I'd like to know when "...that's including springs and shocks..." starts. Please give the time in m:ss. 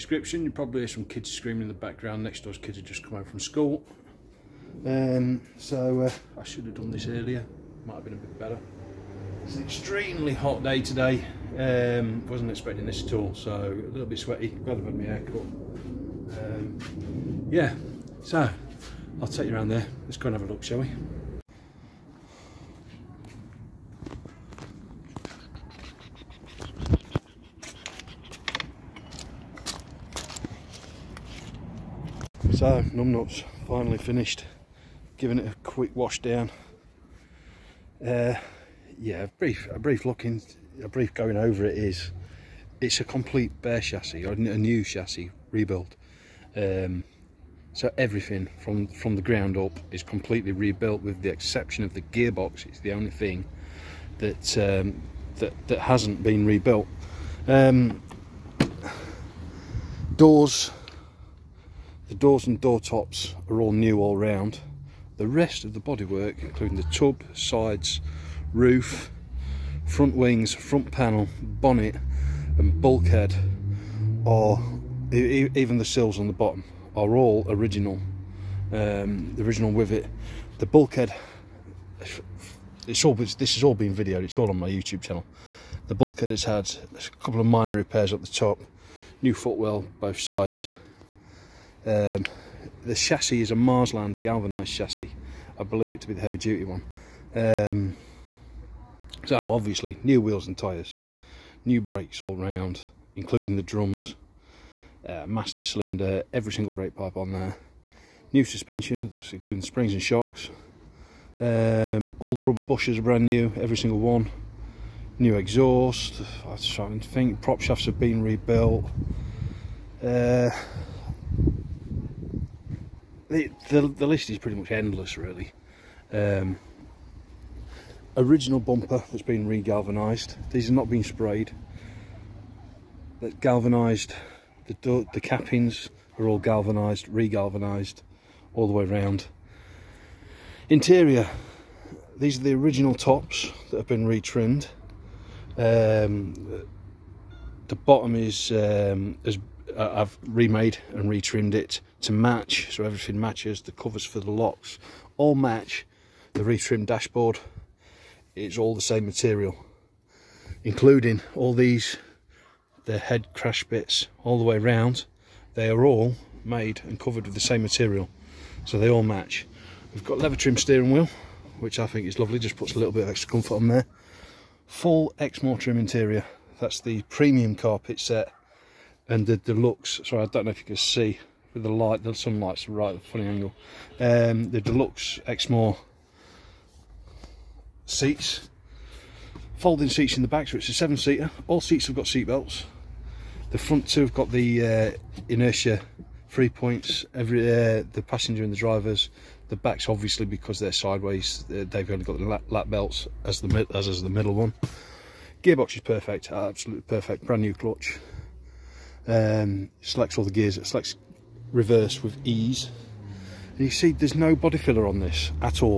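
1:49.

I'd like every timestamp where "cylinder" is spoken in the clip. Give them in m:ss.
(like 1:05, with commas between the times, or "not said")
1:45.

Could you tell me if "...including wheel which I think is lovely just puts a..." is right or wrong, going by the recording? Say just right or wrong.
wrong.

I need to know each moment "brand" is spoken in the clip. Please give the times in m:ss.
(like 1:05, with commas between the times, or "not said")
1:53, 3:27.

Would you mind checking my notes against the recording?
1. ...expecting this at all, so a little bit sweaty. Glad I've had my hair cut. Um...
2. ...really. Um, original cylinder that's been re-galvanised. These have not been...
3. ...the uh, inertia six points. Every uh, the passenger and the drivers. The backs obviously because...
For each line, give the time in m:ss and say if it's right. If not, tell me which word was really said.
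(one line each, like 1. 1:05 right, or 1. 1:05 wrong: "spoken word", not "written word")
1. 0:12 right
2. 2:05 wrong: "bumper", not "cylinder"
3. 3:14 wrong: "three", not "six".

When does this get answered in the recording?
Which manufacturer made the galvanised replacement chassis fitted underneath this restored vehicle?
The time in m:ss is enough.
1:33.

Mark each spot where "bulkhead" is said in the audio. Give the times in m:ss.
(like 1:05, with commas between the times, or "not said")
1:12, 1:20, 1:25.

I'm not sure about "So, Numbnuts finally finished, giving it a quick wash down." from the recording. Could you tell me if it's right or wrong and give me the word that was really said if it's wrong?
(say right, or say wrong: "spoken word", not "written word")
right.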